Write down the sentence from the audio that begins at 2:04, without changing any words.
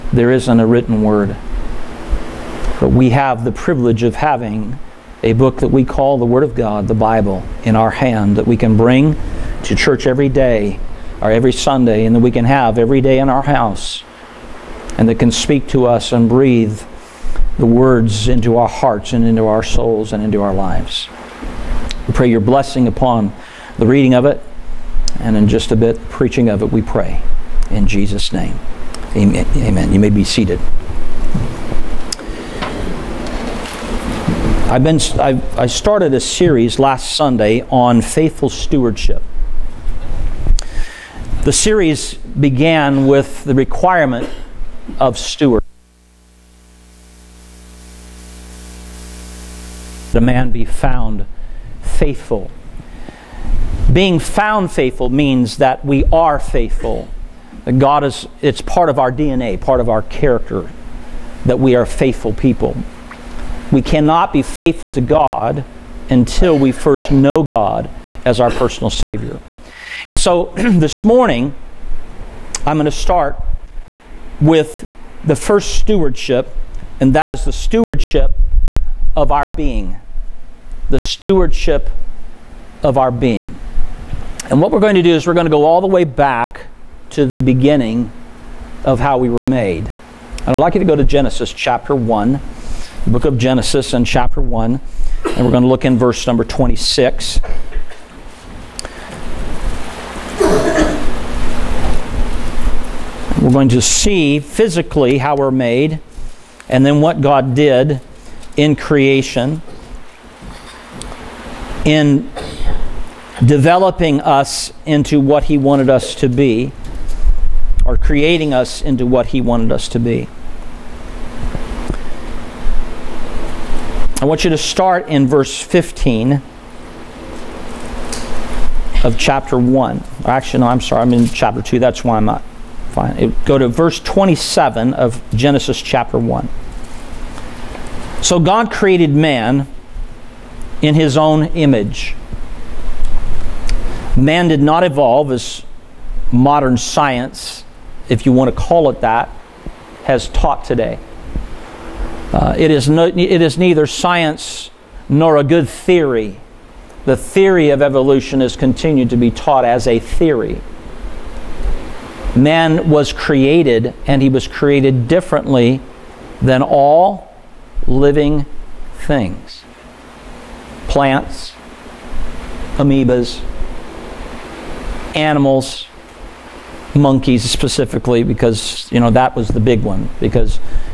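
I want you to start in verse 15 of chapter 1.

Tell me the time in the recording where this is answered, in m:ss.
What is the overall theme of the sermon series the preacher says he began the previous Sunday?
0:38.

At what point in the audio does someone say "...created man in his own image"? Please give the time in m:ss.
2:18.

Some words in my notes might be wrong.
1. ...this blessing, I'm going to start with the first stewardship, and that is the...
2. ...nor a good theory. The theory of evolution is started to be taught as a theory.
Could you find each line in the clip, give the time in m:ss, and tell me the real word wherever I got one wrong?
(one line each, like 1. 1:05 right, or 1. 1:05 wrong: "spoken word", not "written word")
1. 1:10 wrong: "morning", not "blessing"
2. 2:35 wrong: "continued", not "started".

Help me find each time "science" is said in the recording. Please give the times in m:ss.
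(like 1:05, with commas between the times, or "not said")
2:26, 2:33.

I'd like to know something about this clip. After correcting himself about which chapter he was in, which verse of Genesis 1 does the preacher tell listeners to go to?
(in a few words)
27.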